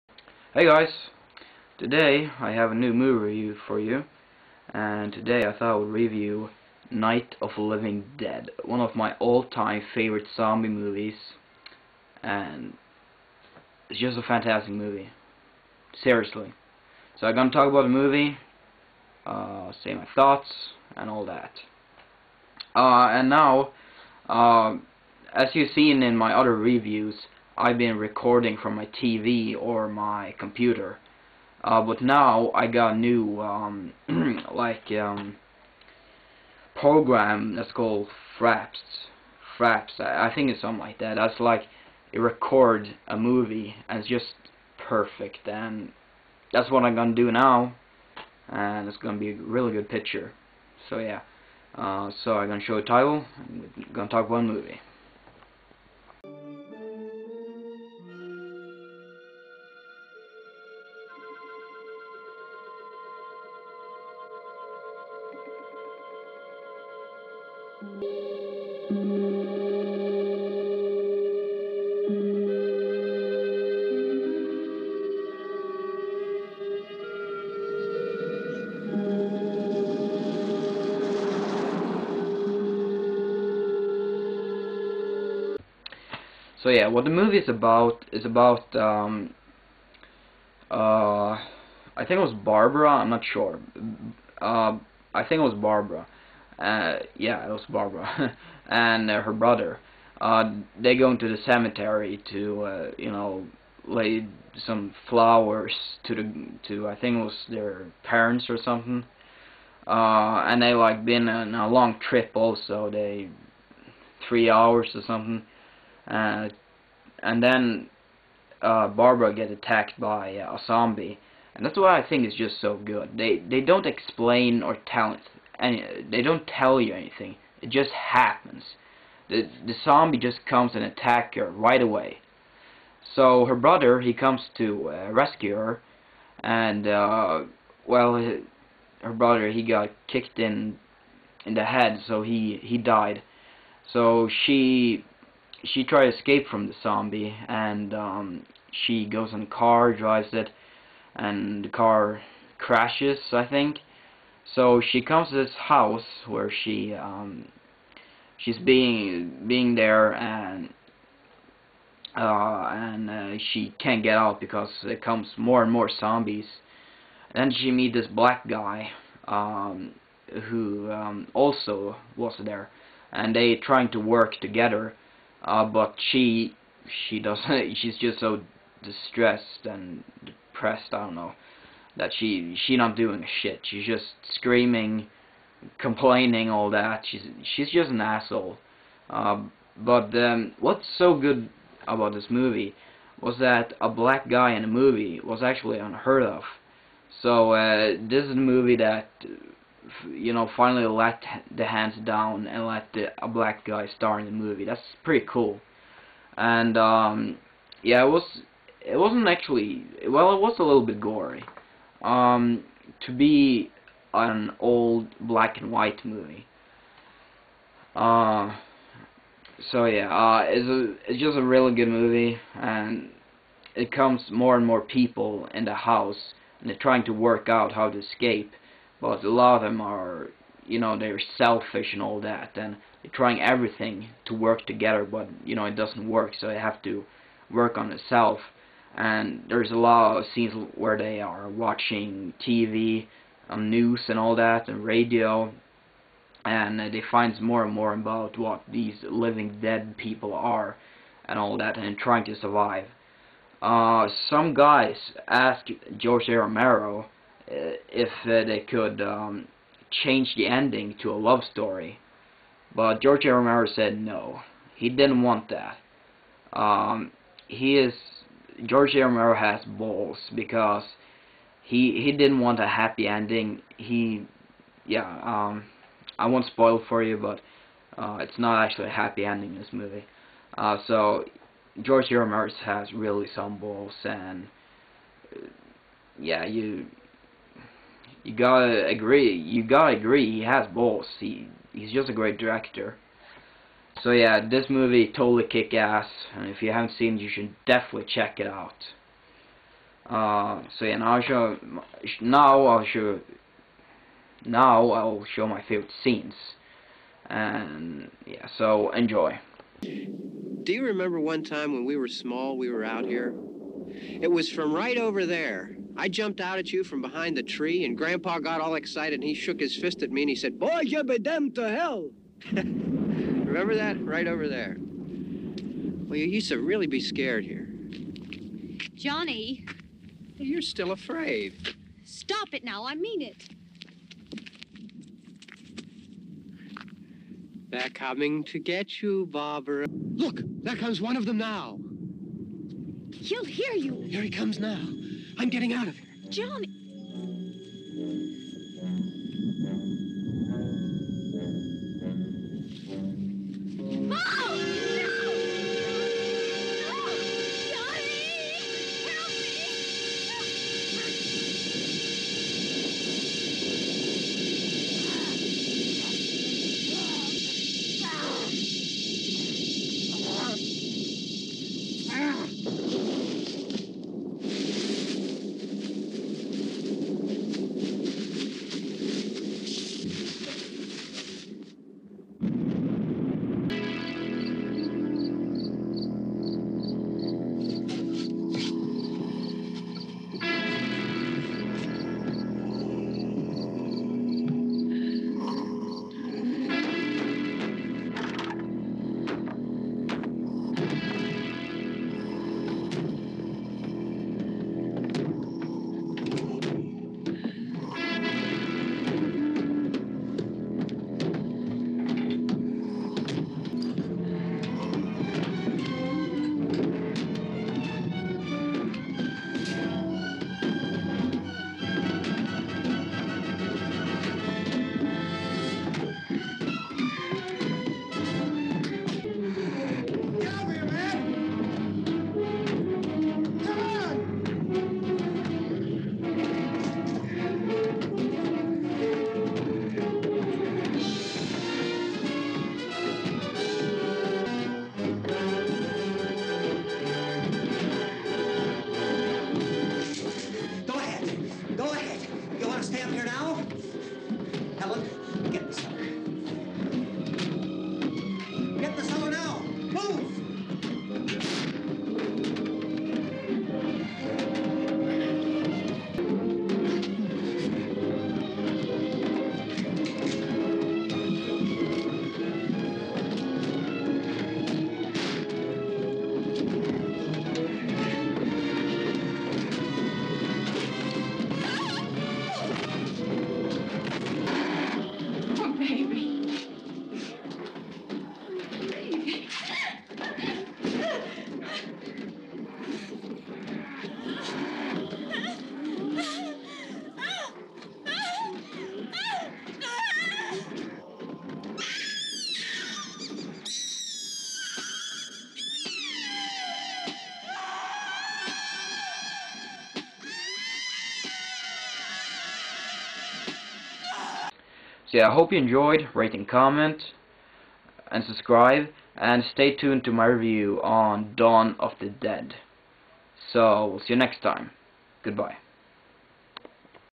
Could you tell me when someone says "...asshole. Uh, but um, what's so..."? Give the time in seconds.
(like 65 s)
188 s.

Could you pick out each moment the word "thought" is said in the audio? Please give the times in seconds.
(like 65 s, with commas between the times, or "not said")
5 s, 20 s.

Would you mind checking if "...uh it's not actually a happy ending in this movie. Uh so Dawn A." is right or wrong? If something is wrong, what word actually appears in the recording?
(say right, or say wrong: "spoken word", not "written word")
wrong: "George", not "Dawn".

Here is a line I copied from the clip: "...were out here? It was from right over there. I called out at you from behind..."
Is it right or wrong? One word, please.
wrong.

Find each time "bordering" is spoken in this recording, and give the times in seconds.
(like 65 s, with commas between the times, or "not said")
not said.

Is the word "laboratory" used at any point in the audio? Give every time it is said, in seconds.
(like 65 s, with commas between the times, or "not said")
not said.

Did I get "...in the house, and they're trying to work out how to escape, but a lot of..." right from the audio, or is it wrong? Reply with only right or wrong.
right.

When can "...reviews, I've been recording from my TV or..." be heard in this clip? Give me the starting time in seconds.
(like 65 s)
26 s.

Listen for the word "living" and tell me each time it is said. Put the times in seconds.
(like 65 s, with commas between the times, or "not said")
7 s, 249 s.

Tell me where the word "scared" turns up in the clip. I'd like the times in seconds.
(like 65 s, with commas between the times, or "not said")
327 s.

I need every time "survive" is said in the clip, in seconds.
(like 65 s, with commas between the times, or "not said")
252 s.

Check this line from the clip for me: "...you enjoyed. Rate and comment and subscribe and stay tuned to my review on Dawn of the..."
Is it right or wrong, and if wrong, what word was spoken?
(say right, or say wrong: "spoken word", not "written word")
right.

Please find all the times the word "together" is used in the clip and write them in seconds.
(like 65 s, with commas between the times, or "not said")
174 s, 234 s.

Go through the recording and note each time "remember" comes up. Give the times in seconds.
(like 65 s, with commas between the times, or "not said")
310 s, 323 s.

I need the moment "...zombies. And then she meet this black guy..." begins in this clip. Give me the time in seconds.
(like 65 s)
165 s.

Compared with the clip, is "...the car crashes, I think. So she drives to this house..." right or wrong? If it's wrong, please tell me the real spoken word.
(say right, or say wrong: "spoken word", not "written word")
wrong: "comes", not "drives".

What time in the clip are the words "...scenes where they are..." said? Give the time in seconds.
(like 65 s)
240 s.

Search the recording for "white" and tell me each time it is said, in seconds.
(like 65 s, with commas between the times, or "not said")
215 s.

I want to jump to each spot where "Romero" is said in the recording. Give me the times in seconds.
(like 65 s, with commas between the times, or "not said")
256 s, 263 s, 269 s, 282 s.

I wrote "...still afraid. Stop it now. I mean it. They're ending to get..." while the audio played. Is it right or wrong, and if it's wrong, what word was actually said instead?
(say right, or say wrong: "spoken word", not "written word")
wrong: "coming", not "ending".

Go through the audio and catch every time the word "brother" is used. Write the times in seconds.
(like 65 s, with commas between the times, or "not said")
99 s, 133 s, 139 s.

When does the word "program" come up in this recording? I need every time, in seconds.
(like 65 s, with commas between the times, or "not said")
36 s.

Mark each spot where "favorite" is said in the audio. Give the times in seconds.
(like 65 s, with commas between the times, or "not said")
9 s, 305 s.